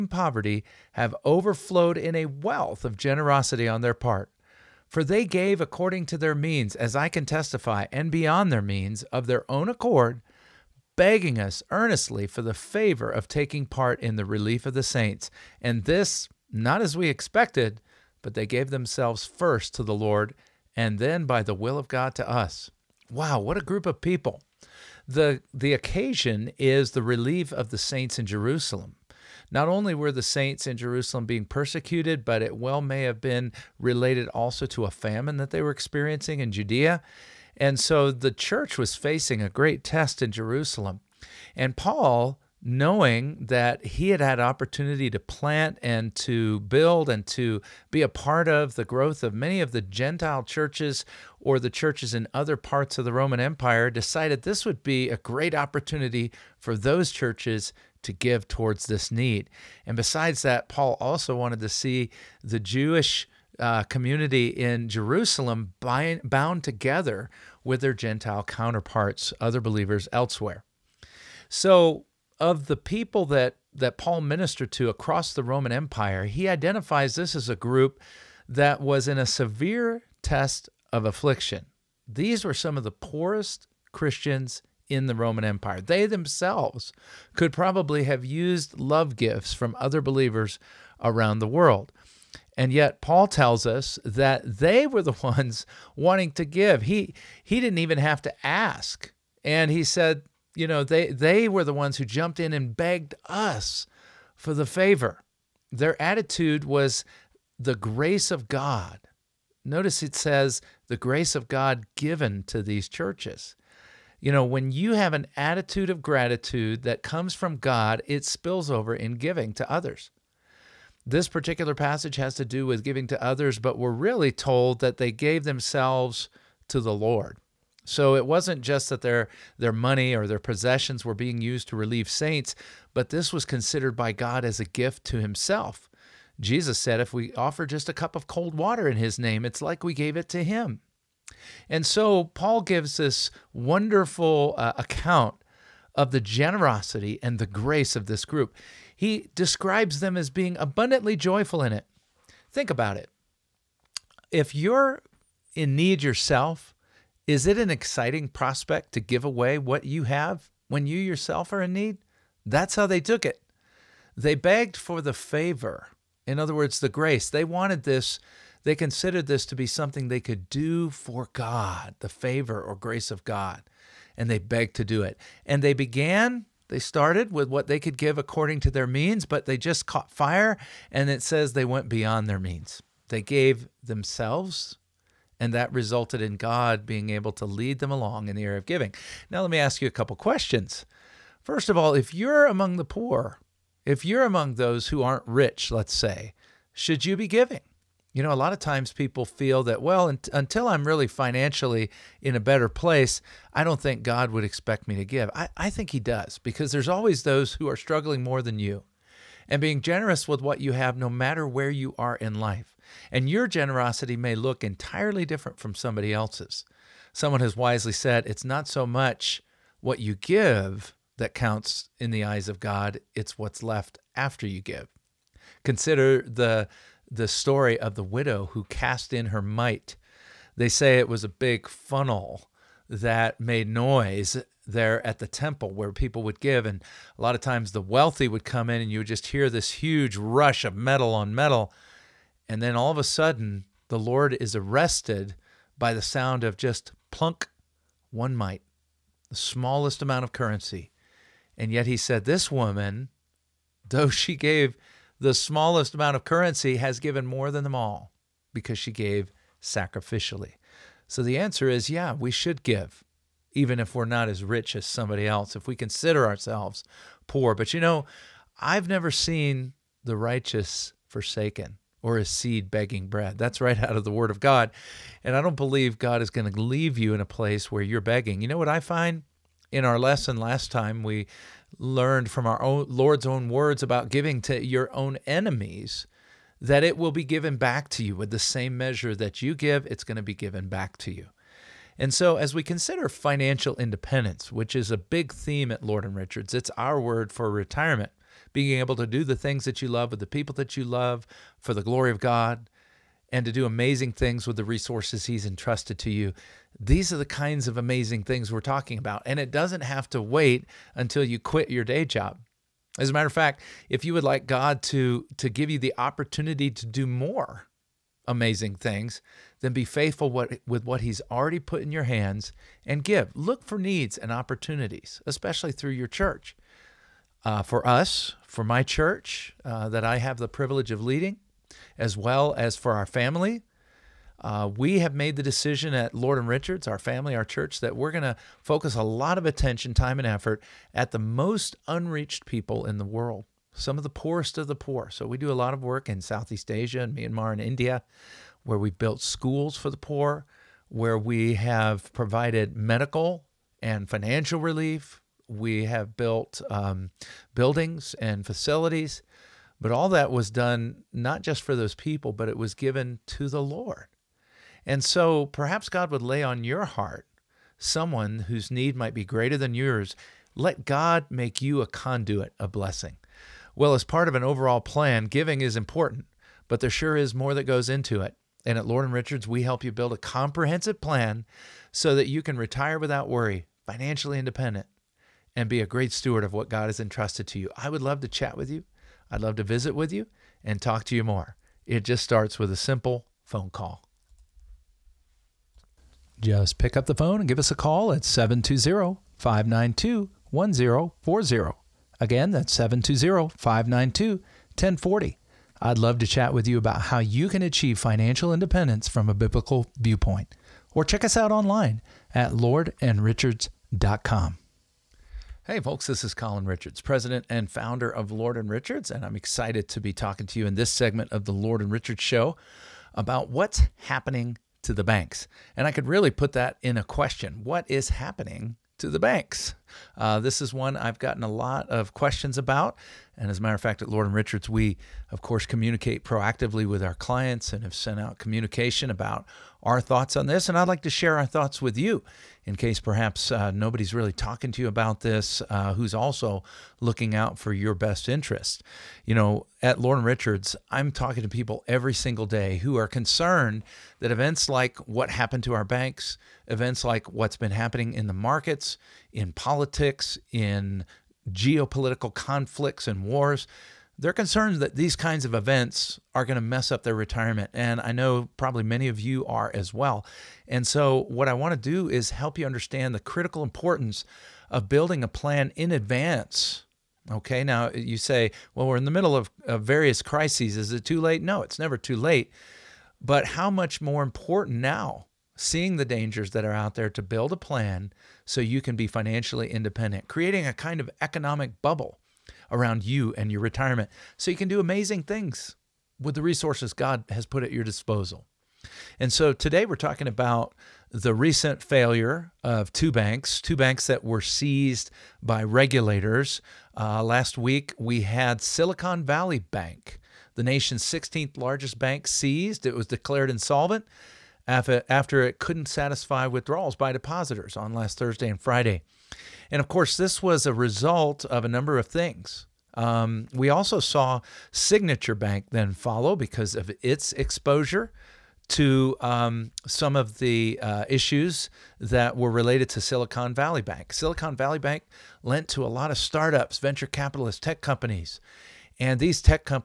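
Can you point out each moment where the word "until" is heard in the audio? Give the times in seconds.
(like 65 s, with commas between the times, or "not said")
200 s, 310 s.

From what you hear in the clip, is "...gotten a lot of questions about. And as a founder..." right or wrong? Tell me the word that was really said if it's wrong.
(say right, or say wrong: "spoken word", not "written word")
wrong: "matter", not "founder".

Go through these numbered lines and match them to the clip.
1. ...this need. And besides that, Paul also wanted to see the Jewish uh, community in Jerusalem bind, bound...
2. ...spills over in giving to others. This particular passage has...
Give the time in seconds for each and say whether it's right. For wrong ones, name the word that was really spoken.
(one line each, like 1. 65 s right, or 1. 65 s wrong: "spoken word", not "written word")
1. 58 s right
2. 118 s right.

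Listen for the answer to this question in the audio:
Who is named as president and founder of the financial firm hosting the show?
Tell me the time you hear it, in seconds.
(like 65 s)
416 s.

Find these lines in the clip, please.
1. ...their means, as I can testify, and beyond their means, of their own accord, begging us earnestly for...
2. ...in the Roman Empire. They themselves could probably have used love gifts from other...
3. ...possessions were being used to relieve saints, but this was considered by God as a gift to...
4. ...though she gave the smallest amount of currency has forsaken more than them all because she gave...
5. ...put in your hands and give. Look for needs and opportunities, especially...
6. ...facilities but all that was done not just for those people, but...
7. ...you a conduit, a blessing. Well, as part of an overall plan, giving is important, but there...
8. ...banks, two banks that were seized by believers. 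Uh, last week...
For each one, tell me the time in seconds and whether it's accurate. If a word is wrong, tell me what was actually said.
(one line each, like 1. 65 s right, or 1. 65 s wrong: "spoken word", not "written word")
1. 6 s right
2. 84 s right
3. 130 s right
4. 253 s wrong: "given", not "forsaken"
5. 321 s right
6. 358 s right
7. 371 s right
8. 503 s wrong: "regulators", not "believers".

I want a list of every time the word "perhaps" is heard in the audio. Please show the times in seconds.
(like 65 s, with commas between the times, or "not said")
365 s, 442 s.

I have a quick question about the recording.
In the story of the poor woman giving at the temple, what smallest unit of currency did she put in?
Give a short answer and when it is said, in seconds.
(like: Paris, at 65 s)
one mite, at 248 s.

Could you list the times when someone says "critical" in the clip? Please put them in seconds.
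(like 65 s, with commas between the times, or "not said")
473 s.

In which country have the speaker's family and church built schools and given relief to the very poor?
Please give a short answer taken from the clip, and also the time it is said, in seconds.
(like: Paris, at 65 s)
Myanmar, at 347 s.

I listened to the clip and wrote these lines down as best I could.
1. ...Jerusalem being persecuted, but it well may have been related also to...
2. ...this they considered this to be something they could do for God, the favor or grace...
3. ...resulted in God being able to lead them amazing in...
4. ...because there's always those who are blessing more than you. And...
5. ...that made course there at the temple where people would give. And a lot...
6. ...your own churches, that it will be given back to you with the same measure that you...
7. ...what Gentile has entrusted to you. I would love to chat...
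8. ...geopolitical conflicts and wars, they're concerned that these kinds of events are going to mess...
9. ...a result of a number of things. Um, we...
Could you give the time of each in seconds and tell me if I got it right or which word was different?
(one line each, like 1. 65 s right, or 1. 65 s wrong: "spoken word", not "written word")
1. 30 s right
2. 167 s right
3. 185 s wrong: "along", not "amazing"
4. 206 s wrong: "struggling", not "blessing"
5. 232 s wrong: "noise", not "course"
6. 284 s wrong: "enemies", not "churches"
7. 386 s wrong: "God", not "Gentile"
8. 461 s right
9. 520 s right.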